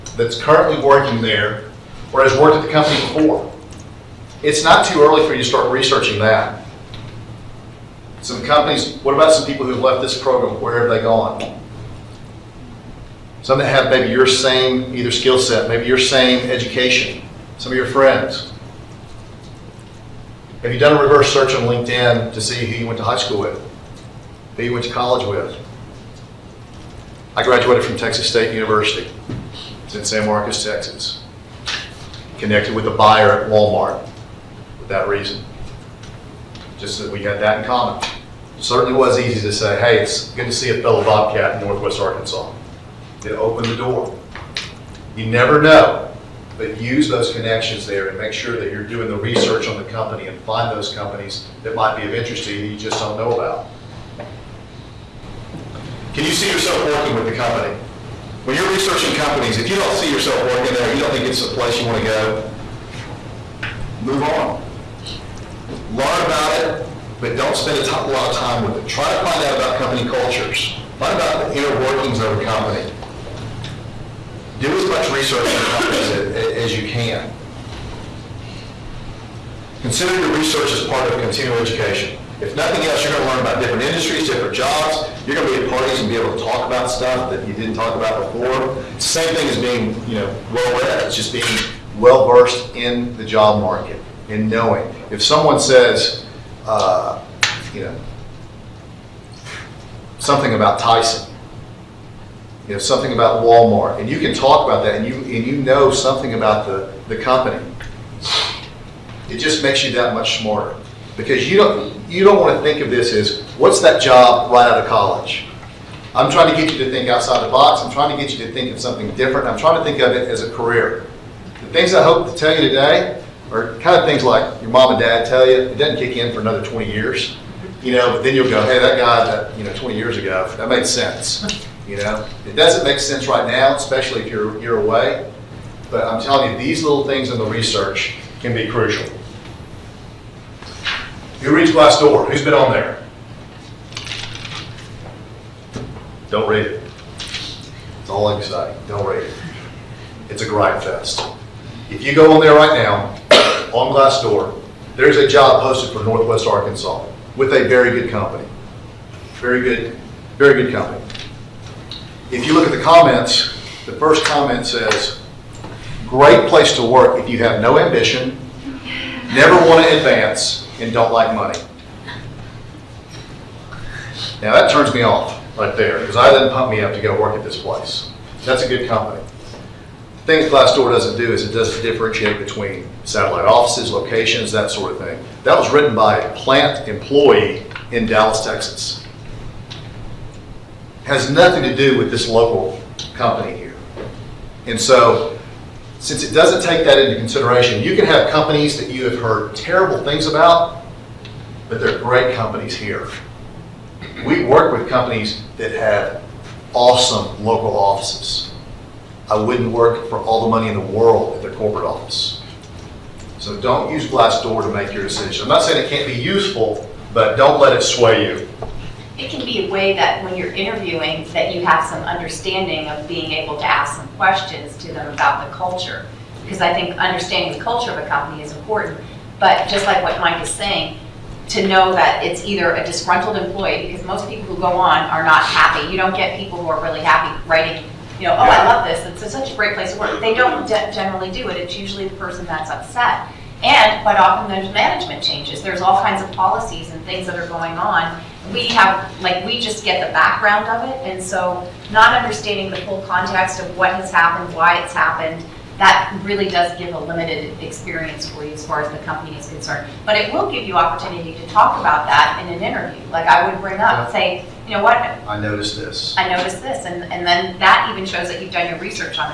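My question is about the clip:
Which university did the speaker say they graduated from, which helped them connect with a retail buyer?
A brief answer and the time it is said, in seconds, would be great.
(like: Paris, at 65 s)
Texas State University, at 27 s.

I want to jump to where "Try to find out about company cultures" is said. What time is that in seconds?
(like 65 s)
68 s.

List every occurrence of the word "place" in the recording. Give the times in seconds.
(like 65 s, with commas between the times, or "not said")
61 s, 166 s, 177 s, 239 s.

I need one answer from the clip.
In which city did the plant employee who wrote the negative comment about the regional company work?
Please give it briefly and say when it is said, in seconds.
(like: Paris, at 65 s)
Dallas, Texas, at 188 s.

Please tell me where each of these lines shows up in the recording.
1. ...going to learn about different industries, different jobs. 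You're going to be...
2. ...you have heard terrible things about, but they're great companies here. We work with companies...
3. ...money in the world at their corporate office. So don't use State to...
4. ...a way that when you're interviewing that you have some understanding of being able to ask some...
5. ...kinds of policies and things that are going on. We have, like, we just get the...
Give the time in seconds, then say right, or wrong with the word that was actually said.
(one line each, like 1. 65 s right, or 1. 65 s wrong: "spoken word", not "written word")
1. 83 s right
2. 198 s right
3. 210 s wrong: "Glassdoor", not "State"
4. 219 s right
5. 246 s right.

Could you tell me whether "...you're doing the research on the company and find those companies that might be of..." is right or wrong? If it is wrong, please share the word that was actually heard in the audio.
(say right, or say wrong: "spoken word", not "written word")
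right.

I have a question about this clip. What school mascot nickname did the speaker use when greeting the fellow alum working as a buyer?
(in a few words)
Bobcat.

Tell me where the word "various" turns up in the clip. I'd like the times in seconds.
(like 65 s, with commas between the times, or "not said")
not said.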